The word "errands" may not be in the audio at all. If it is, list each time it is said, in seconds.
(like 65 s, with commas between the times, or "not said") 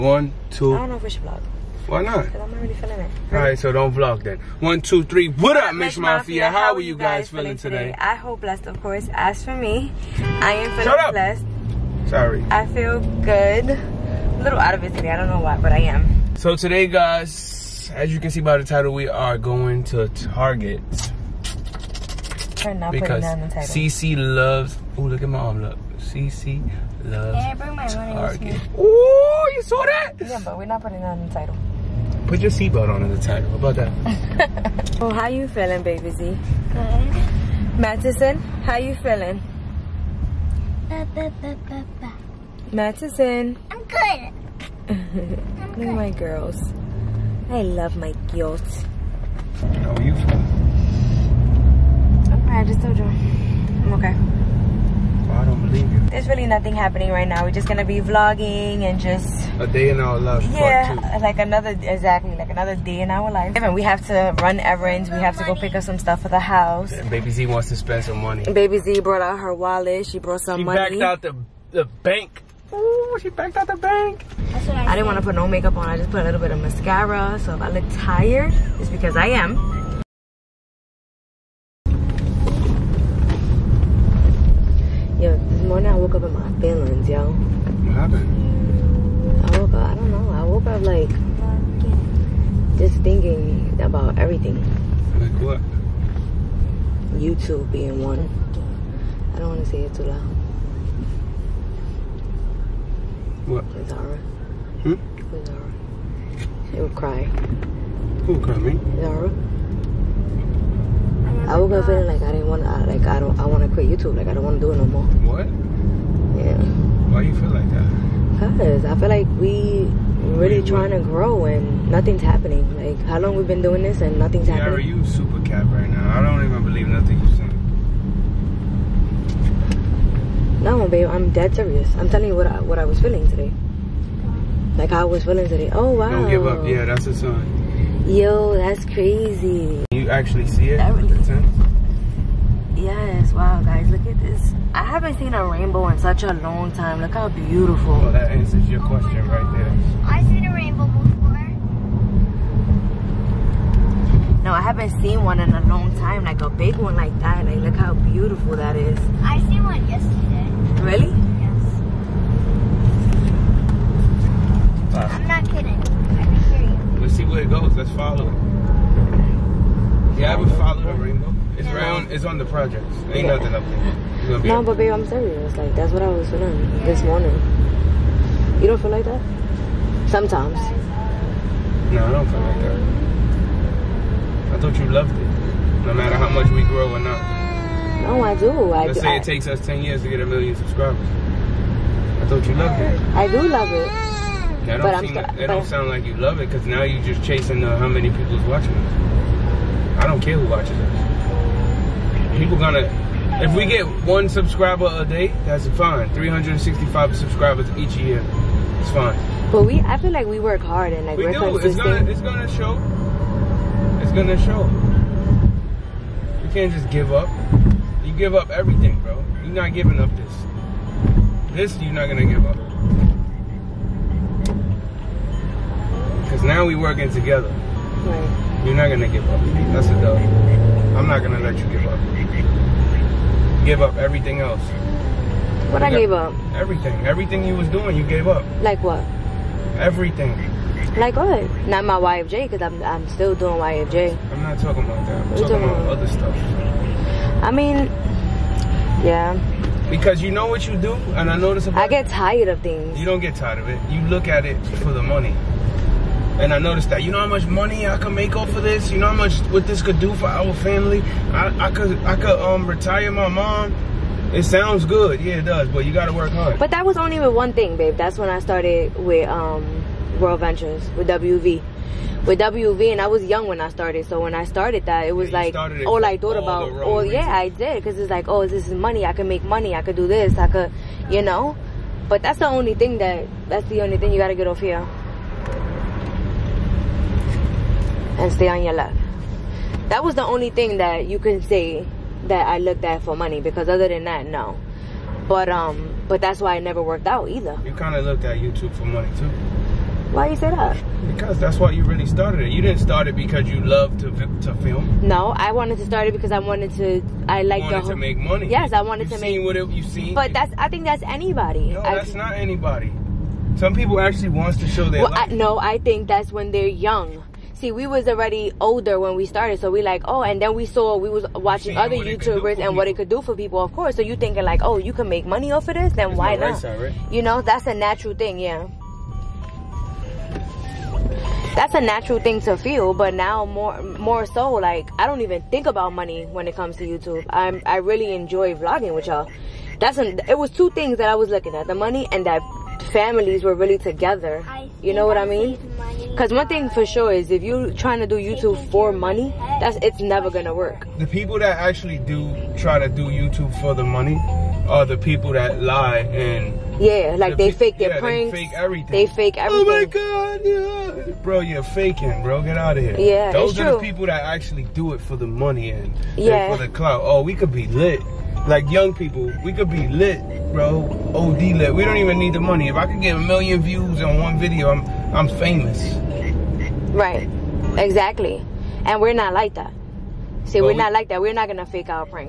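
64 s.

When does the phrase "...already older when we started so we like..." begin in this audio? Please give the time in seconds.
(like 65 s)
318 s.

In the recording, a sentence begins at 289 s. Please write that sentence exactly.
That was the only thing that you can say that I looked at for money because other than that, no.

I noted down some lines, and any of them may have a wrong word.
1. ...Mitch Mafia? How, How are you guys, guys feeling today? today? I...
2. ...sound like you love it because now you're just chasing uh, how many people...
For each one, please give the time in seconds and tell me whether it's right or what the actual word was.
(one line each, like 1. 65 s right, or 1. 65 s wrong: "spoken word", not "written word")
1. 5 s right
2. 195 s right.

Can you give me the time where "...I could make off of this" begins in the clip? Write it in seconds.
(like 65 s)
257 s.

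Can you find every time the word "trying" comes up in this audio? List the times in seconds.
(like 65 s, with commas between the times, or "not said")
120 s, 347 s.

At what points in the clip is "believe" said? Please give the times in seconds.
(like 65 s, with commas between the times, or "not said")
55 s, 126 s.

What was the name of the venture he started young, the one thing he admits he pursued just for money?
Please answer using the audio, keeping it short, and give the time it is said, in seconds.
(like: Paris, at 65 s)
World Ventures, at 270 s.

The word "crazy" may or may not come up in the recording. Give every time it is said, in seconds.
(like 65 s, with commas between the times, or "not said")
138 s.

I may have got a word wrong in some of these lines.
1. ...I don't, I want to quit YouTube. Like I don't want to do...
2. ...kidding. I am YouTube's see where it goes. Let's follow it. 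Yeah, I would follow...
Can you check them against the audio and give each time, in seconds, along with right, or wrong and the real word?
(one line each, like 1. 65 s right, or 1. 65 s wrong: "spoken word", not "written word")
1. 113 s right
2. 165 s wrong: "Let", not "YouTube".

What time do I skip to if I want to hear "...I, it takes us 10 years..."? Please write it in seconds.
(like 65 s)
189 s.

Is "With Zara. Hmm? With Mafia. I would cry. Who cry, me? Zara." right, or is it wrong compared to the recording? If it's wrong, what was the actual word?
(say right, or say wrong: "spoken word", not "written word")
wrong: "Zara", not "Mafia".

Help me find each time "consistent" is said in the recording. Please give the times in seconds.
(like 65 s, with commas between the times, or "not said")
211 s.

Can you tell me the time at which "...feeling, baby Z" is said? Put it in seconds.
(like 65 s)
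35 s.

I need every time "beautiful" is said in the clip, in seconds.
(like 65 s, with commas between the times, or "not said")
147 s, 157 s.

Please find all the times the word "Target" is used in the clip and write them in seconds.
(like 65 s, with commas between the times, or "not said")
20 s, 28 s.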